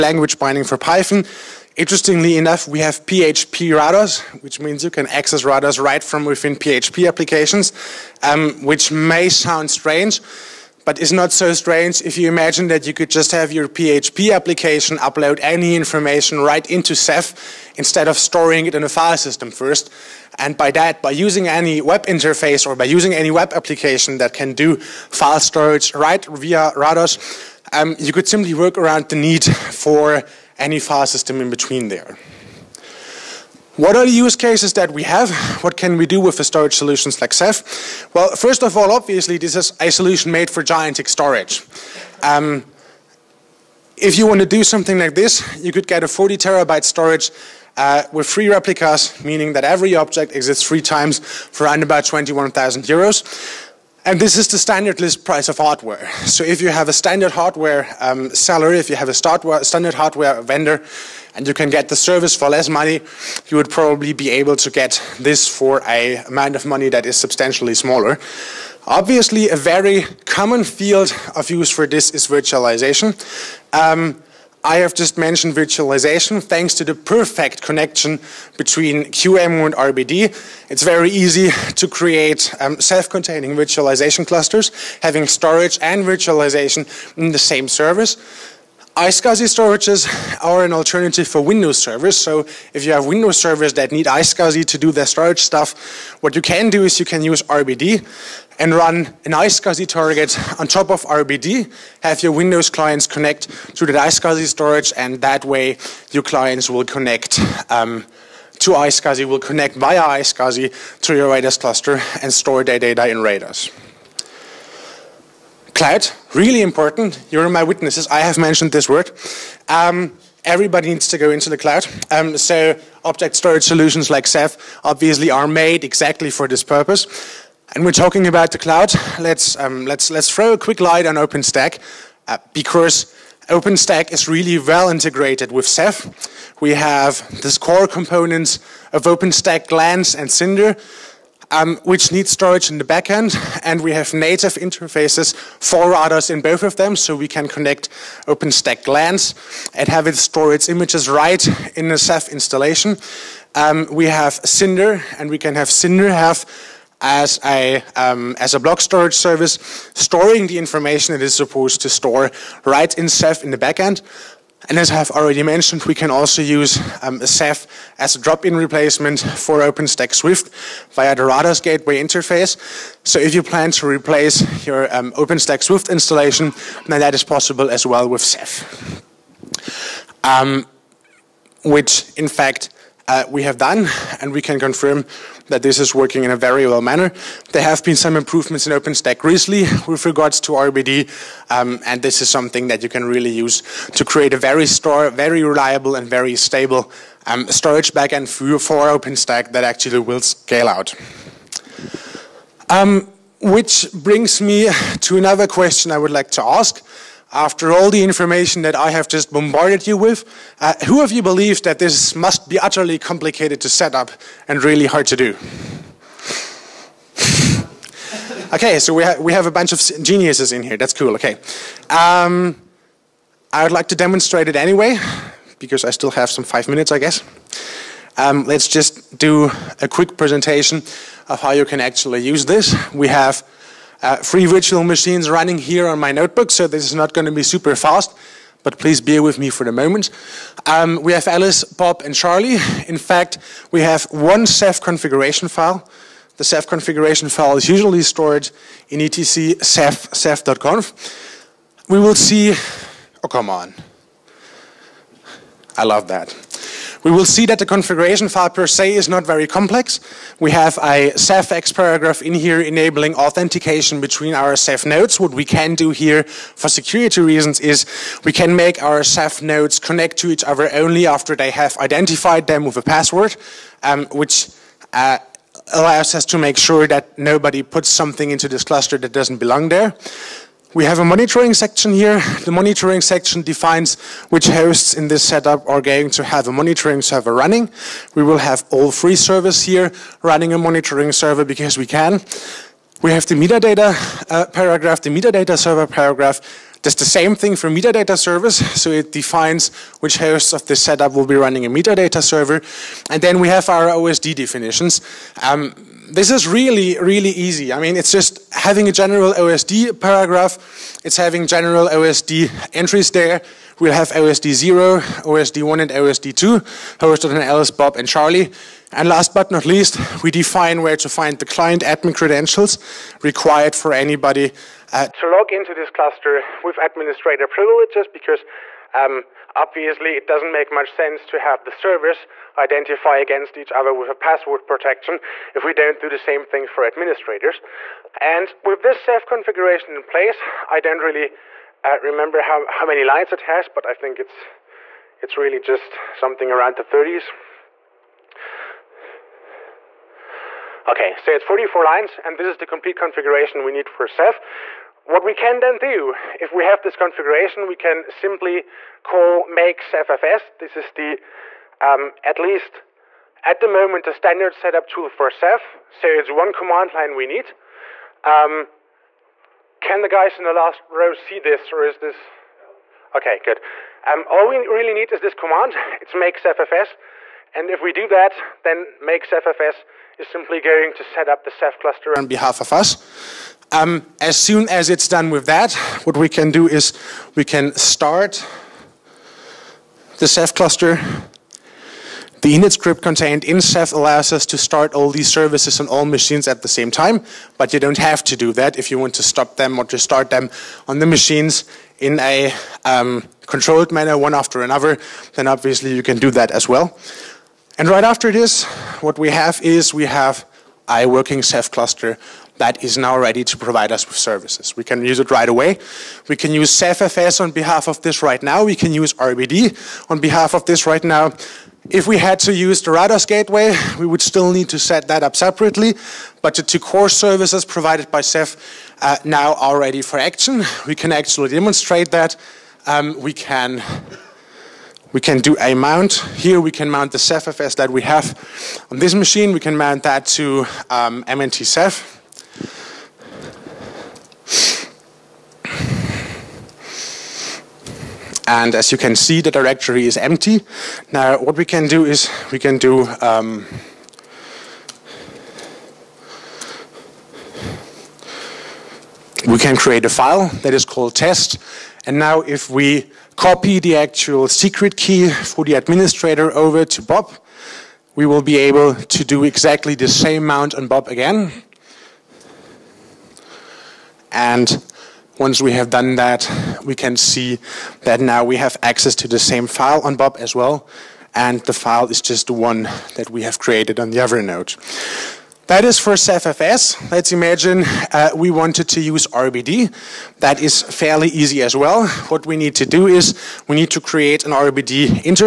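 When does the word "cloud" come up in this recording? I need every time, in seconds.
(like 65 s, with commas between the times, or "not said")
115 s, 121 s, 128 s.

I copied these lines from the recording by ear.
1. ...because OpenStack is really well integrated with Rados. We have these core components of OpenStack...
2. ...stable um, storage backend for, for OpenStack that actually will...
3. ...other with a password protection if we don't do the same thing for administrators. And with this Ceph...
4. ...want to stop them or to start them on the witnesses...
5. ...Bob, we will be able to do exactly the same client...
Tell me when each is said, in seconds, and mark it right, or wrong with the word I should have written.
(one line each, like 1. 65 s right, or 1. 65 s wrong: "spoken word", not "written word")
1. 132 s wrong: "Ceph", not "Rados"
2. 196 s right
3. 333 s right
4. 398 s wrong: "machines", not "witnesses"
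5. 467 s wrong: "mount", not "client".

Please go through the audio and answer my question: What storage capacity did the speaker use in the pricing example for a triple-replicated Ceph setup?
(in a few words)
40 terabytes.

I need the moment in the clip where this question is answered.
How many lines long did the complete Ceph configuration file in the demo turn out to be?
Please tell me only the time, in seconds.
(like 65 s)
351 s.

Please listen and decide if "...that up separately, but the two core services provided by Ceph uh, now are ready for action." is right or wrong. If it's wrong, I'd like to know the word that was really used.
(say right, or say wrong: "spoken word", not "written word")
right.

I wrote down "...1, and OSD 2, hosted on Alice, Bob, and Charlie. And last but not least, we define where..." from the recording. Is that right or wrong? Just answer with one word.
right.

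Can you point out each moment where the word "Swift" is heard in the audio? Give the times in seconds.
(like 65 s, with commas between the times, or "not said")
170 s, 175 s.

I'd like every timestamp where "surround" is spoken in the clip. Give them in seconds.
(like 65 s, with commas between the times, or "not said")
not said.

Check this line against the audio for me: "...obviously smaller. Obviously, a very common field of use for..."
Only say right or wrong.
wrong.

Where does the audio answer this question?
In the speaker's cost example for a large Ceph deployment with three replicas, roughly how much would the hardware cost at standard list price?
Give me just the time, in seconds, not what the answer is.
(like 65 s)
52 s.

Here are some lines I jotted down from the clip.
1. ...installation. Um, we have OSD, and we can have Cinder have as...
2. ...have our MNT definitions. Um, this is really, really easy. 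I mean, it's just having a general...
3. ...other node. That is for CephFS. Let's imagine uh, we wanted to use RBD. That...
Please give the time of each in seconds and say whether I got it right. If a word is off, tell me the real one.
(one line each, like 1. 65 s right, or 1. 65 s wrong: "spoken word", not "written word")
1. 152 s wrong: "Cinder", not "OSD"
2. 303 s wrong: "OSD", not "MNT"
3. 484 s right.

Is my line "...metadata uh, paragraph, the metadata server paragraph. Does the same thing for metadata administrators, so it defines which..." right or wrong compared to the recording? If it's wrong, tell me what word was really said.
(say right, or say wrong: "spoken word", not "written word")
wrong: "servers", not "administrators".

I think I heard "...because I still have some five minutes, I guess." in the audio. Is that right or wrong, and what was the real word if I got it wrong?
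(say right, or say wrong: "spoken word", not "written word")
right.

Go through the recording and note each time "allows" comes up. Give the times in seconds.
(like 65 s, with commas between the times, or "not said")
275 s, 393 s.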